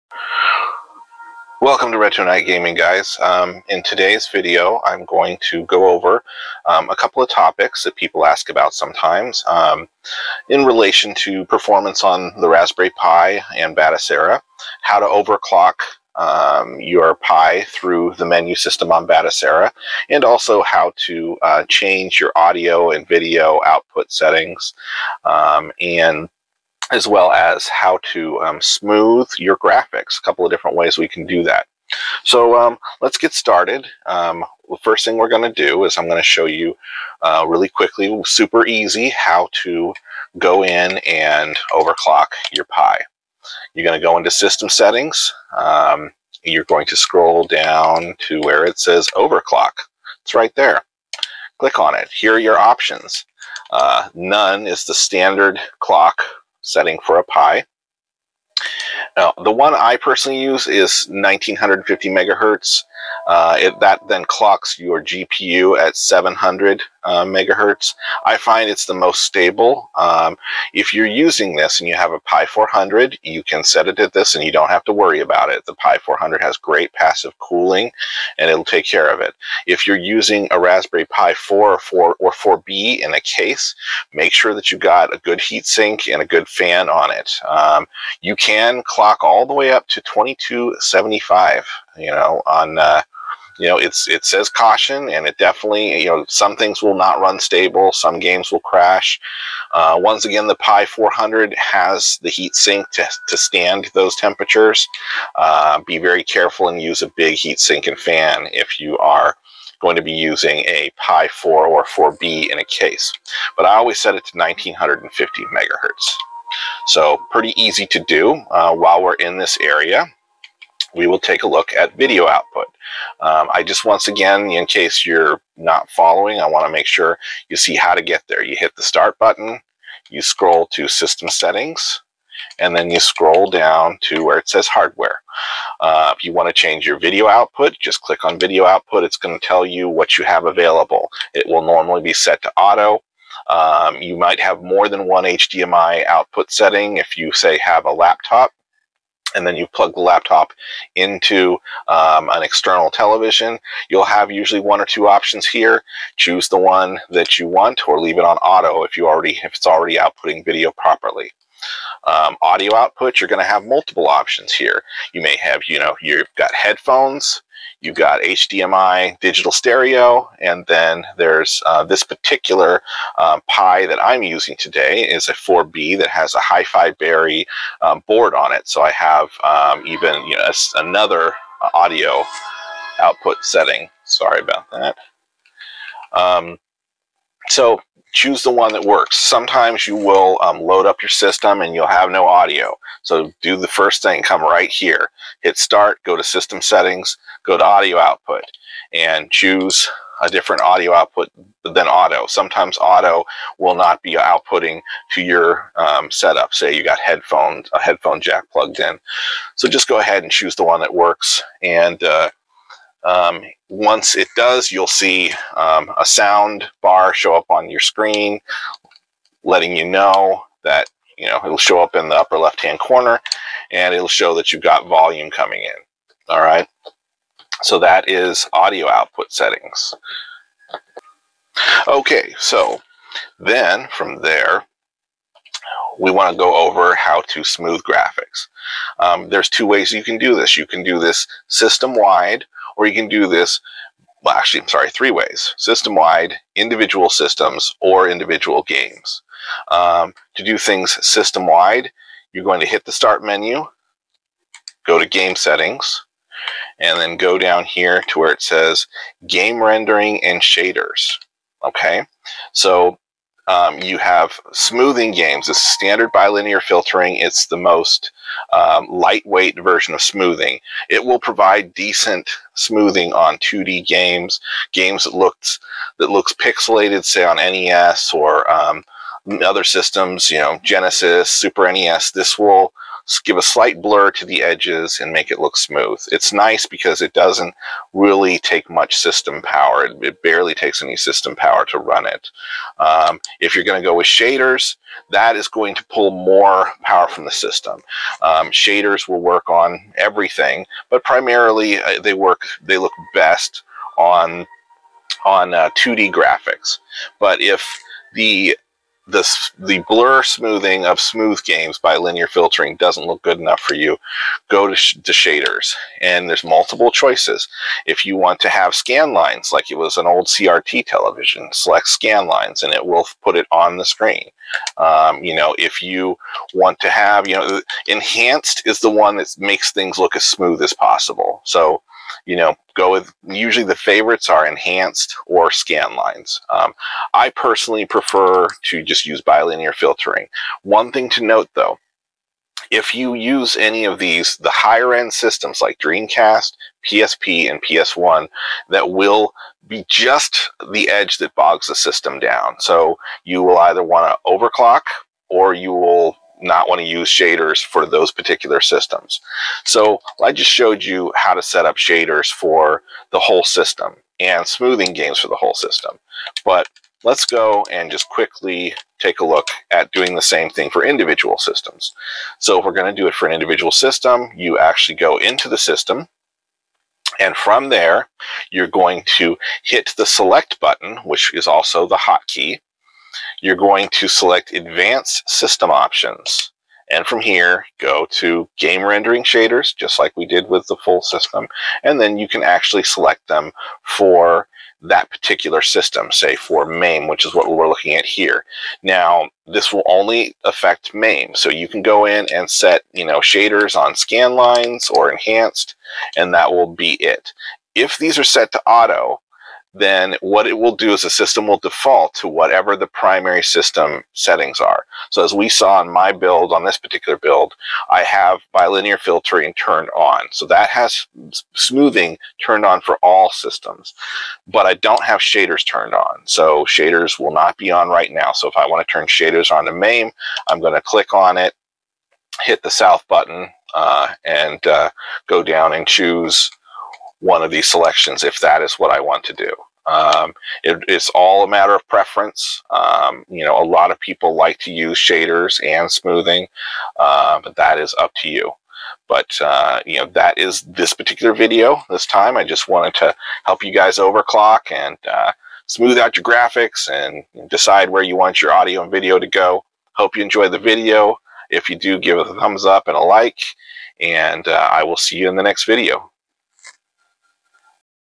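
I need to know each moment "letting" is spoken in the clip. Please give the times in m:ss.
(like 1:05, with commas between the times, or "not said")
3:39.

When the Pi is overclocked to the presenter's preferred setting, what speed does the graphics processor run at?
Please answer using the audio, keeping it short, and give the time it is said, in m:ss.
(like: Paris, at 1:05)
700 MHz, at 1:05.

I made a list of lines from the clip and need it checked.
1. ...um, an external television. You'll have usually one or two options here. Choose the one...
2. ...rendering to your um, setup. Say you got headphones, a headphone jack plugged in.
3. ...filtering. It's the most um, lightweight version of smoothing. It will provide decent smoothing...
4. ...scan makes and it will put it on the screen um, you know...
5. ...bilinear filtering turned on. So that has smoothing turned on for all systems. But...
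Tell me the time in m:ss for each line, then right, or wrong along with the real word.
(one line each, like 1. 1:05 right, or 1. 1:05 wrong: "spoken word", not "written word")
1. 2:31 right
2. 3:24 wrong: "outputting", not "rendering"
3. 4:26 right
4. 5:21 wrong: "lines", not "makes"
5. 6:58 right.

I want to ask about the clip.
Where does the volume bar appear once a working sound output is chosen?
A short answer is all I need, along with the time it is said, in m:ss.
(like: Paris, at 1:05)
upper left-hand corner, at 3:42.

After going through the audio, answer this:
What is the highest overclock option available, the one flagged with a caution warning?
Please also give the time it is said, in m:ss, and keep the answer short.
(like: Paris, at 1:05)
2275, at 1:30.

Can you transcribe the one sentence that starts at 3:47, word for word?
So that is audio output settings.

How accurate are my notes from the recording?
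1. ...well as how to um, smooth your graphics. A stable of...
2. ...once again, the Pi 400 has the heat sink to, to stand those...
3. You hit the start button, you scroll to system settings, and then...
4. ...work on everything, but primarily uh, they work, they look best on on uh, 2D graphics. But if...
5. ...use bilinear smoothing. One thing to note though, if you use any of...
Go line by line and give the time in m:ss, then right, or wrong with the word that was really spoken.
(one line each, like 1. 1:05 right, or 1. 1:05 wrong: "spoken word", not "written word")
1. 0:27 wrong: "couple", not "stable"
2. 1:39 right
3. 2:08 right
4. 4:59 right
5. 5:39 wrong: "filtering", not "smoothing".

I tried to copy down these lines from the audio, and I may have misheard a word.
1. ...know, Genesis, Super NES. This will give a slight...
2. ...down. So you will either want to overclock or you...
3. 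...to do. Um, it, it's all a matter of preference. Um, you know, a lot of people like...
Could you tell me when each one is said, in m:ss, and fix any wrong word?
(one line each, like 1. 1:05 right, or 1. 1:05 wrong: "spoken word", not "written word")
1. 4:40 right
2. 5:52 right
3. 7:19 right.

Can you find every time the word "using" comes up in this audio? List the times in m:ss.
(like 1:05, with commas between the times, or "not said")
1:11, 1:19, 1:50, 2:54.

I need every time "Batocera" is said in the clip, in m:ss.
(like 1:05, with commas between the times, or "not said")
0:13, 0:19.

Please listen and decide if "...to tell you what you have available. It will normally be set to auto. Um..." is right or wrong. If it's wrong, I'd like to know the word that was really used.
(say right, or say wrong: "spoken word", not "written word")
right.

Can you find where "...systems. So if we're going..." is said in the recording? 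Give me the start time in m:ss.
6:11.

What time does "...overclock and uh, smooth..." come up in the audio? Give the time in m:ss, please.
7:33.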